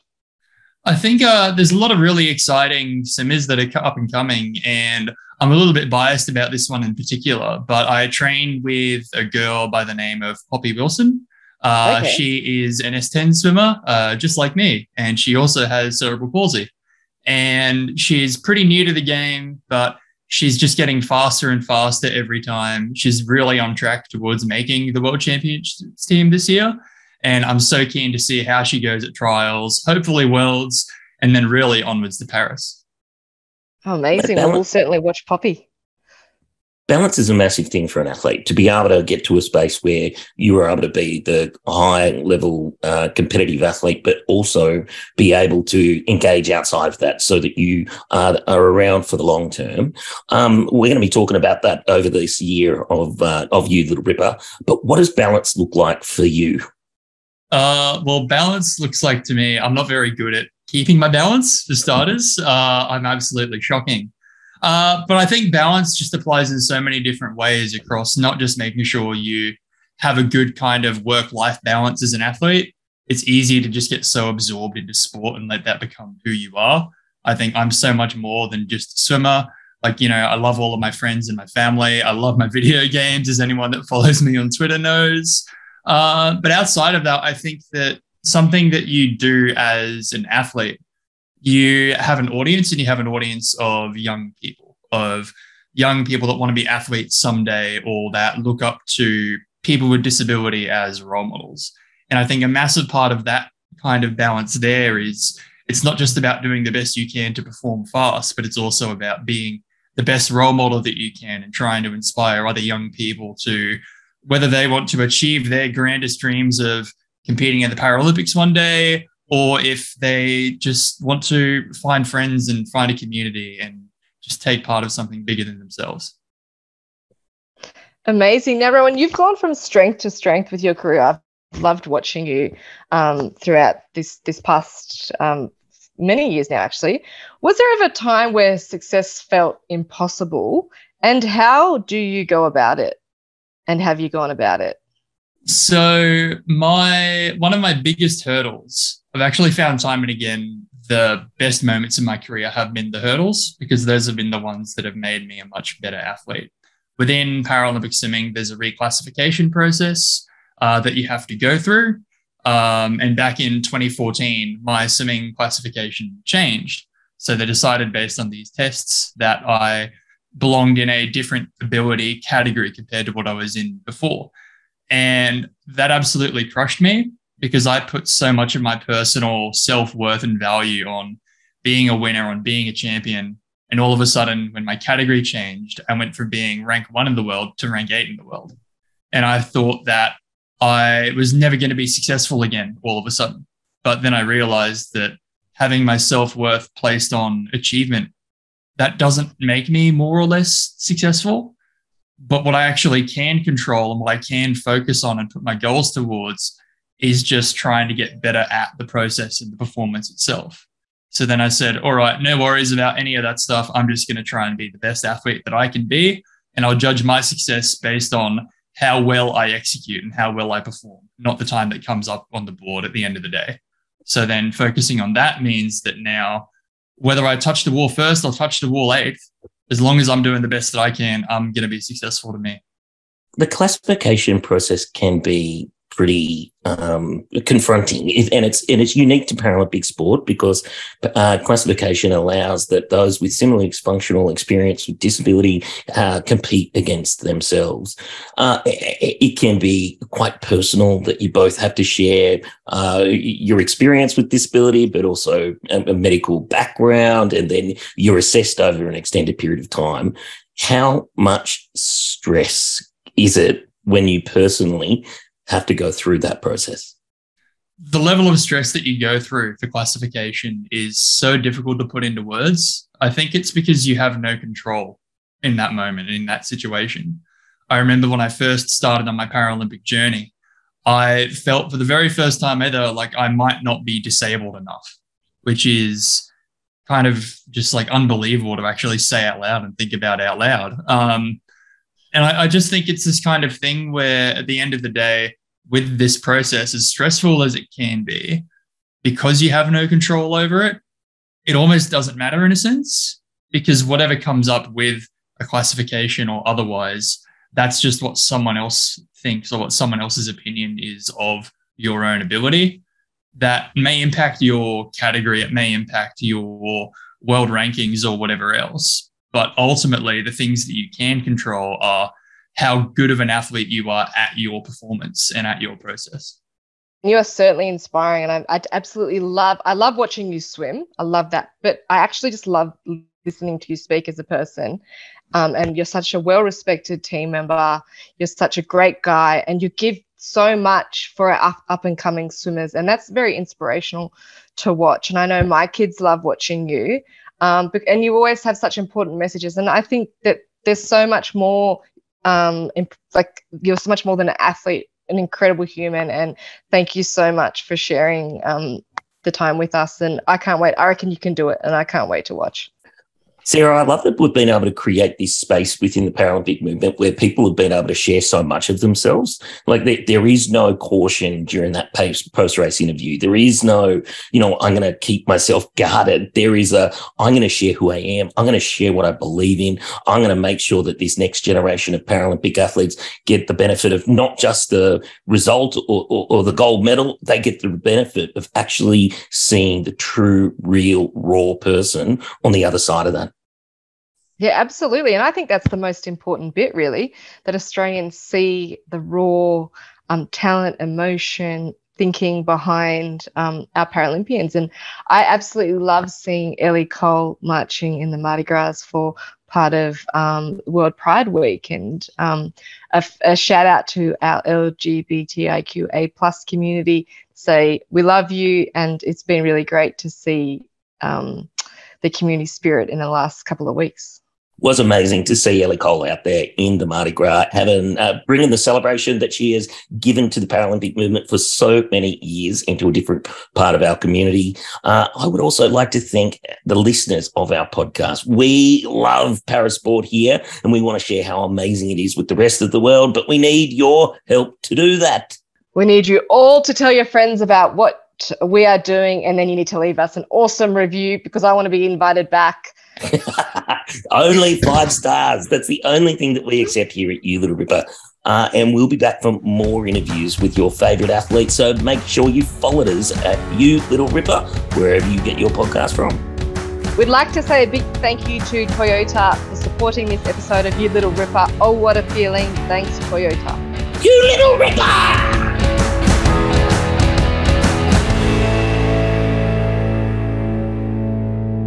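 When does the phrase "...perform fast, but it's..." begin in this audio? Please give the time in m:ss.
1:47.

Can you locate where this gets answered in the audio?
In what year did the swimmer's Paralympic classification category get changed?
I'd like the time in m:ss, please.
2:43.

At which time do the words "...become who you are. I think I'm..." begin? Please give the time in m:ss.
1:15.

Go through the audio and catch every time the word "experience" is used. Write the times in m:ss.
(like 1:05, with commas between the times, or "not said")
4:04, 4:13.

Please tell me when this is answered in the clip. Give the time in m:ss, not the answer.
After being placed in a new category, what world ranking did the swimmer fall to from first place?
3:07.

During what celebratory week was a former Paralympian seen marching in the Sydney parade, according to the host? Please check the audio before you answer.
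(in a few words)
World Pride Week.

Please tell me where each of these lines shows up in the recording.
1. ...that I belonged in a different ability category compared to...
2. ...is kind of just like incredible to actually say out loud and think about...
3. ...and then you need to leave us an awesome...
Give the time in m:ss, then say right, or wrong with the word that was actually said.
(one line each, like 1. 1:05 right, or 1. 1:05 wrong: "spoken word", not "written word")
1. 2:49 right
2. 4:45 wrong: "unbelievable", not "incredible"
3. 7:29 right.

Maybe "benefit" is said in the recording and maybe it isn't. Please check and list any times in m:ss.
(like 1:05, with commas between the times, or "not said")
6:23, 6:27.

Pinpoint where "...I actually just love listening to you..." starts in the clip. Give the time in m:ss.
5:31.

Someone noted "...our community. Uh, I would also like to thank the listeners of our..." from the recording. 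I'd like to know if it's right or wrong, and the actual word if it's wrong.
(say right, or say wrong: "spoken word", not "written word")
right.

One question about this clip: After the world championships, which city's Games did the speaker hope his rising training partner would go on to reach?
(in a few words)
Paris.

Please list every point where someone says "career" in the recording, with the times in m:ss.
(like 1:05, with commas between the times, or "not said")
2:10, 2:32.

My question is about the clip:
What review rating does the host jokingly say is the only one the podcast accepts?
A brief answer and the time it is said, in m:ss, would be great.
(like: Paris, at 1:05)
5 stars, at 7:34.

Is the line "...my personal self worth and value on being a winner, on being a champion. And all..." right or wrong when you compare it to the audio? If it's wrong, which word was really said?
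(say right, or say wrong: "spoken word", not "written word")
right.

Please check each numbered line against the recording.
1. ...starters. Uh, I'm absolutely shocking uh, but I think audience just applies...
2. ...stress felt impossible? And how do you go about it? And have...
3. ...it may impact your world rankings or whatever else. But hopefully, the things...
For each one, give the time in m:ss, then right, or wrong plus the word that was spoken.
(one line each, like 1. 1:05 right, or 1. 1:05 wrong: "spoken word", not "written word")
1. 1:01 wrong: "balance", not "audience"
2. 2:18 wrong: "success", not "stress"
3. 5:15 wrong: "ultimately", not "hopefully".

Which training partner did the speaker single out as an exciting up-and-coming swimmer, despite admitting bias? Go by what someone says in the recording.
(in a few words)
Poppy Wilson.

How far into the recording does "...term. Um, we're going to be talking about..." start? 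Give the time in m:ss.
0:49.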